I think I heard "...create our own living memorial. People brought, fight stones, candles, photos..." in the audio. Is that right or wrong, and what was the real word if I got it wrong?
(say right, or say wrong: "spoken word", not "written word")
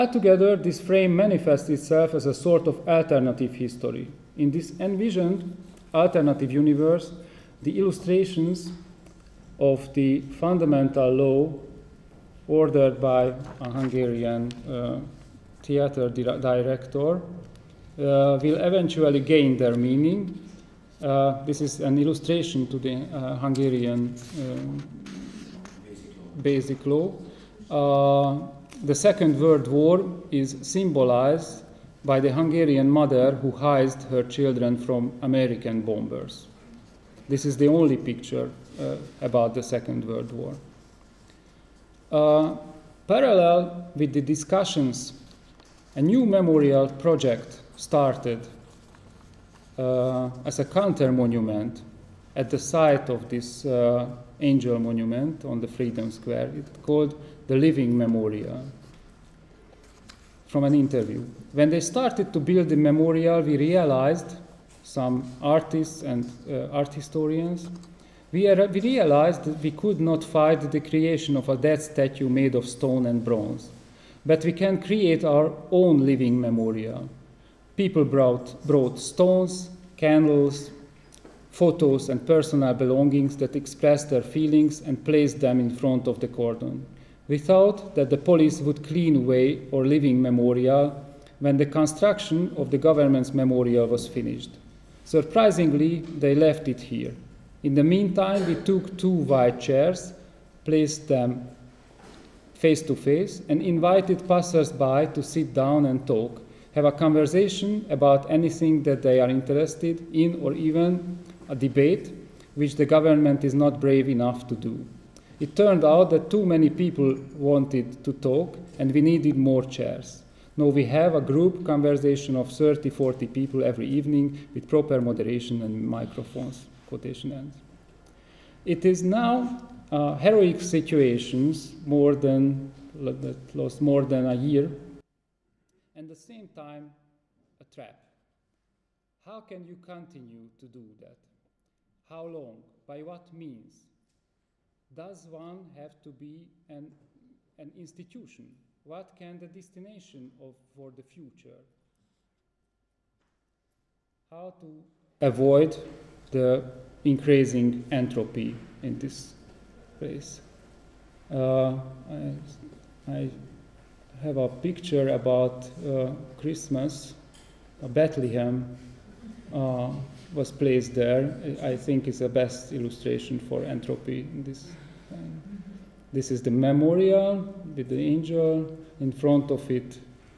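wrong: "brought", not "fight".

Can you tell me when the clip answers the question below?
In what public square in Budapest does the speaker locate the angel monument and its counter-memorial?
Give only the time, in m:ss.
0:55.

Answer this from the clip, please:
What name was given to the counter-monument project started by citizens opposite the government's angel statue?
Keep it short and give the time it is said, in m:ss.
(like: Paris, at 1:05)
The living memorial, at 0:57.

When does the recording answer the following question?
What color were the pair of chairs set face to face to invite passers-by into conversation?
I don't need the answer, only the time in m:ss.
1:39.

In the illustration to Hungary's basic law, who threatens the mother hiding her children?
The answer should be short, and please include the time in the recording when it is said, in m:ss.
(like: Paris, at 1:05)
American bombers, at 0:35.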